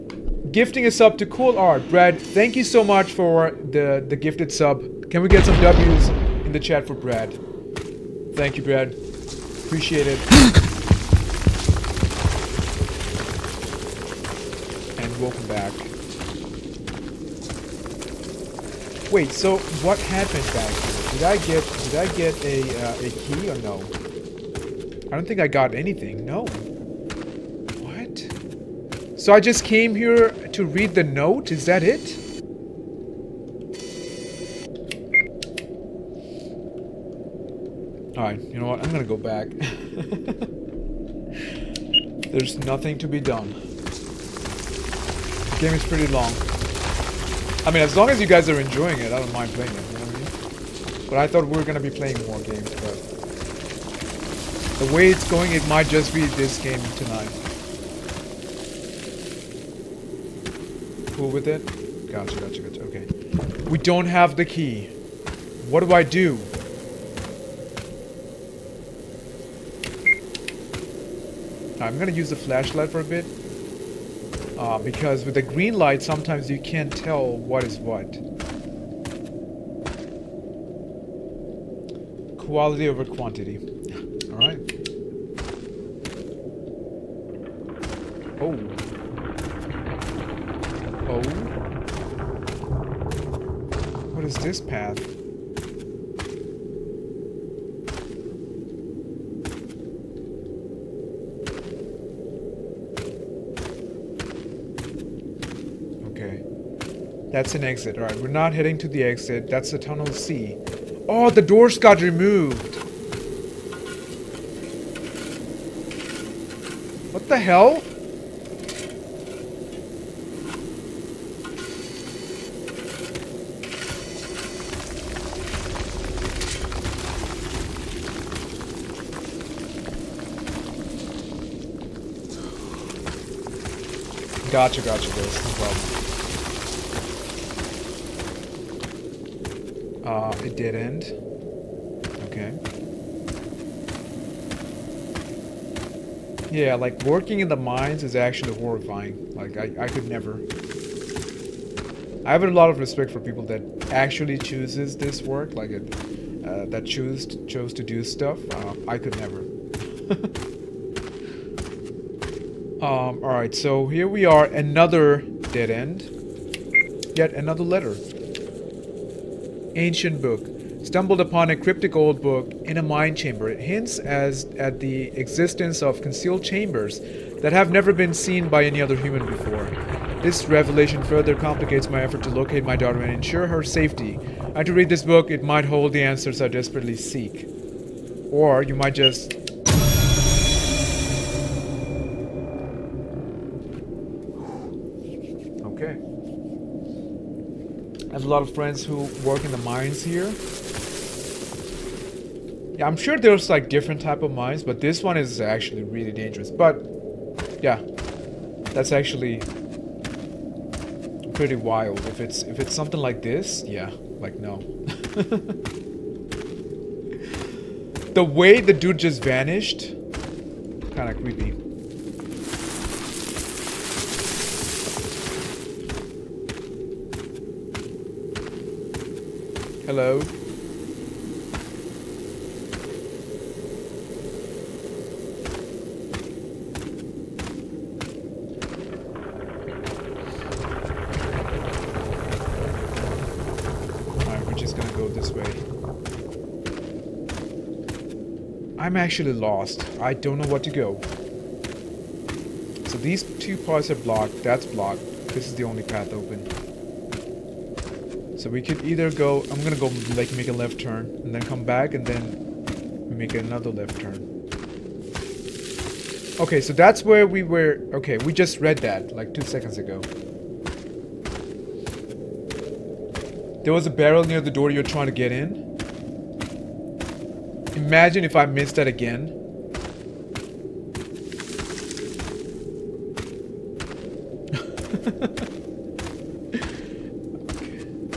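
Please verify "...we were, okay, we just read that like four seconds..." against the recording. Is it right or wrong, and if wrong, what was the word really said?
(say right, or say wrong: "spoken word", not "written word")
wrong: "two", not "four".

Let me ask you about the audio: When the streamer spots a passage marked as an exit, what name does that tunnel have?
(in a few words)
Tunnel C.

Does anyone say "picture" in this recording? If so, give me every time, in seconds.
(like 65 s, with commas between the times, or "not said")
not said.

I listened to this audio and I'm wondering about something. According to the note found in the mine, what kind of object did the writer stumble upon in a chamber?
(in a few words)
Ancient book.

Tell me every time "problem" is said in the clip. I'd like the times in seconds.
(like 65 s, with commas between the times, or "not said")
135 s.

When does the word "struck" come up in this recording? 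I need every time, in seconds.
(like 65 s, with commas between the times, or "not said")
not said.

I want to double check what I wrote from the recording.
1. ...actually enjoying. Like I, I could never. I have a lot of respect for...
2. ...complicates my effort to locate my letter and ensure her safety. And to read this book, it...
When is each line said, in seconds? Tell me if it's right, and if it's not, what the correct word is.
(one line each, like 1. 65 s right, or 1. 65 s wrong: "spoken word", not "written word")
1. 148 s wrong: "horrifying", not "enjoying"
2. 181 s wrong: "daughter", not "letter".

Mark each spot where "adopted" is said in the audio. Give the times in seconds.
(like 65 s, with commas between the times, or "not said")
not said.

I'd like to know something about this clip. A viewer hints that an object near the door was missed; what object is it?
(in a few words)
A barrel.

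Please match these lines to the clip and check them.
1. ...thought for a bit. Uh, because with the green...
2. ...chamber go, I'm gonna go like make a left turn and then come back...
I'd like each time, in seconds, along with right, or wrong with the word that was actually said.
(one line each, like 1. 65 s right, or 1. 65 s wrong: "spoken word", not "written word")
1. 72 s wrong: "flashlight", not "thought"
2. 258 s wrong: "either", not "chamber".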